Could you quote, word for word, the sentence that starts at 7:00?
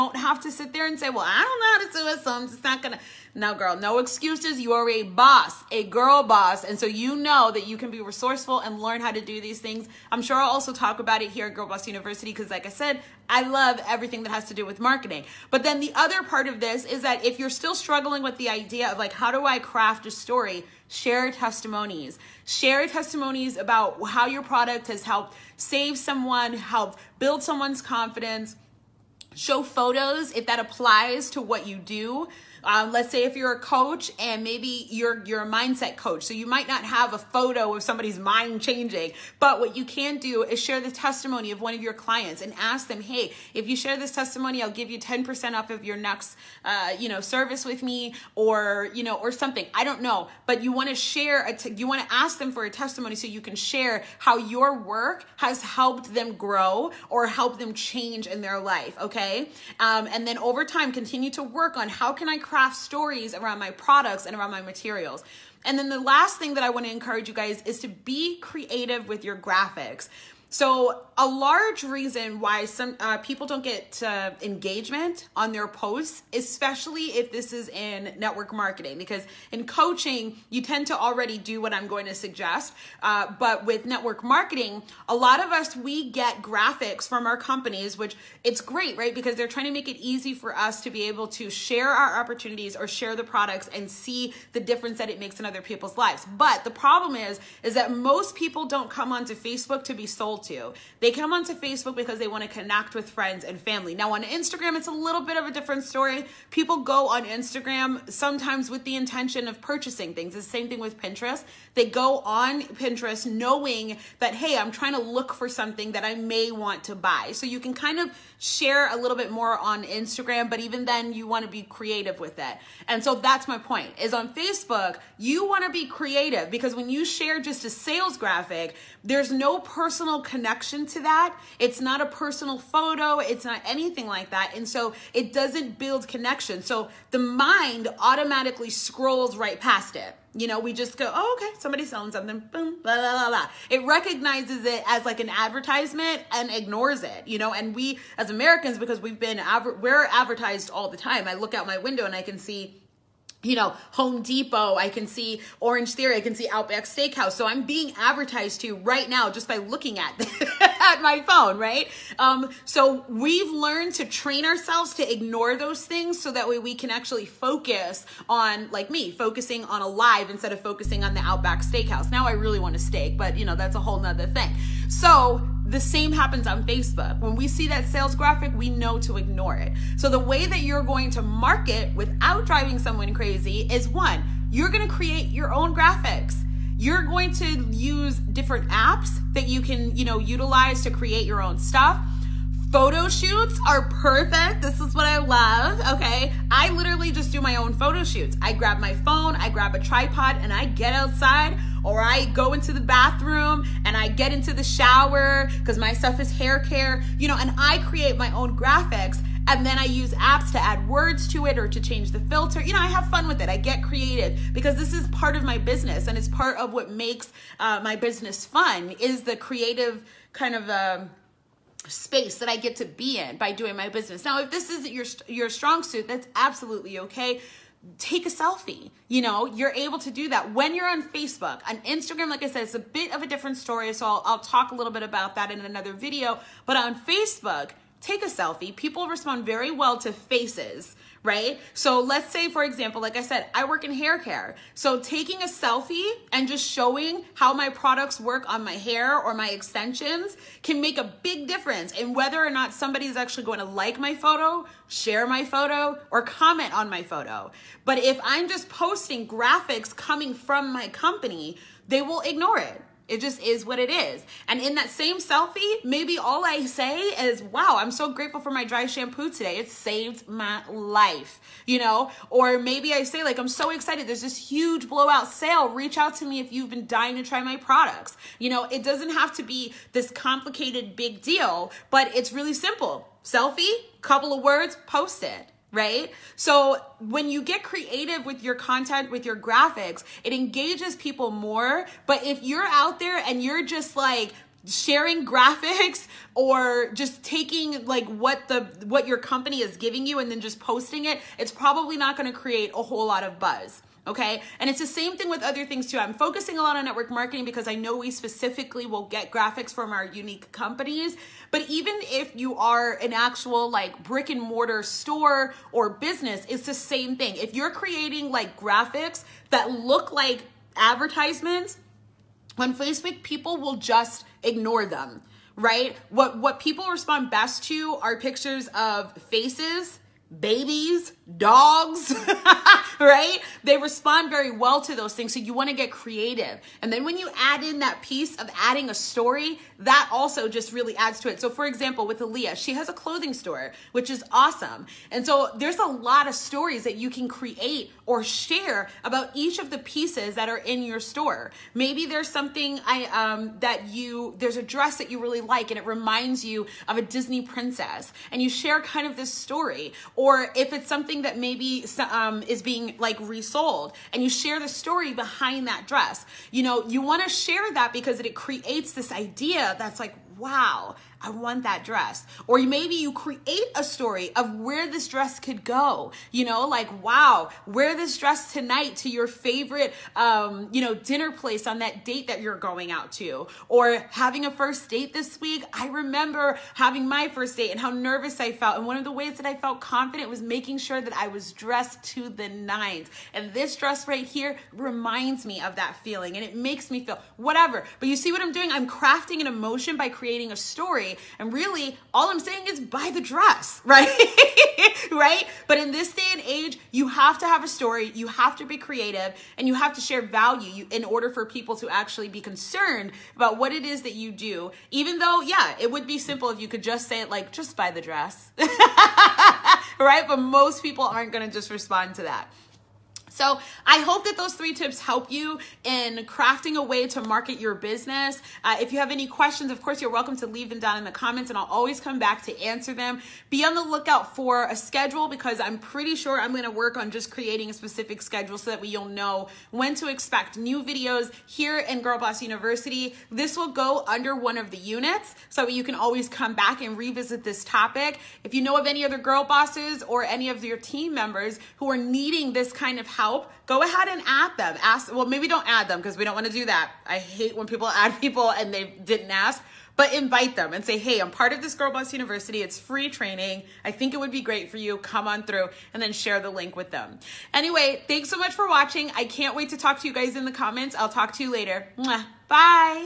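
But most people aren't gonna just respond to that.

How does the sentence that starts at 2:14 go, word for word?
And so it doesn't build connection.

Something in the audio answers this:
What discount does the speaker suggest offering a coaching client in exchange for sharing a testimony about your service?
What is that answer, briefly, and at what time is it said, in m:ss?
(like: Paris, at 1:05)
10%, at 0:44.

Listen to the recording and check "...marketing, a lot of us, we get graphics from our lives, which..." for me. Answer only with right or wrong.
wrong.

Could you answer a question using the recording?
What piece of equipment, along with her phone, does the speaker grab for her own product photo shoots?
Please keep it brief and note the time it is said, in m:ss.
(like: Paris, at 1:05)
A tripod, at 3:19.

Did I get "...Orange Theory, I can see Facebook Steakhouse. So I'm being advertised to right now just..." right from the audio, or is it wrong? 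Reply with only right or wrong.
wrong.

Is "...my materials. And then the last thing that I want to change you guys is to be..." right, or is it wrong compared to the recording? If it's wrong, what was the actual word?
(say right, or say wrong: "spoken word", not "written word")
wrong: "encourage", not "change".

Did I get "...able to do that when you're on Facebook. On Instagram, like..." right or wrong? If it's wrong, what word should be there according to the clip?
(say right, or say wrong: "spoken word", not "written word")
right.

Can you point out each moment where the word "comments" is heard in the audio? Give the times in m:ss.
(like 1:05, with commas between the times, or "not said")
4:16, 7:11, 7:50.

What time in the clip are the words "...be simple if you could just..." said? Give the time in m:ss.
6:56.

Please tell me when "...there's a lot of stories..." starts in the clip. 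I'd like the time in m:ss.
5:45.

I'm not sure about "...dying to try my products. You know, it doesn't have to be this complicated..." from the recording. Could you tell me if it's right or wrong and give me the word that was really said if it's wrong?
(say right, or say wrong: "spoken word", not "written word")
right.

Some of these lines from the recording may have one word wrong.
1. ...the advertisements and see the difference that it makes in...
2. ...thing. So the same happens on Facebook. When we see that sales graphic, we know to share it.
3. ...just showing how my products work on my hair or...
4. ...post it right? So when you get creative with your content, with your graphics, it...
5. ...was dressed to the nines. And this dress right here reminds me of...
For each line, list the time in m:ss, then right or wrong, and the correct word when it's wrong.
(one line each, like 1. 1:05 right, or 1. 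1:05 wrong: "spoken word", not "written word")
1. 1:33 wrong: "products", not "advertisements"
2. 2:54 wrong: "ignore", not "share"
3. 4:06 right
4. 4:44 right
5. 6:31 right.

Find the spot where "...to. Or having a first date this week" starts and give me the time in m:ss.
6:23.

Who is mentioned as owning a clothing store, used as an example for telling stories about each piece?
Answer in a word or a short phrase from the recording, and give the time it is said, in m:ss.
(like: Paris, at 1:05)
Aaliyah, at 5:42.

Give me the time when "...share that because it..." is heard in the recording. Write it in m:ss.
6:07.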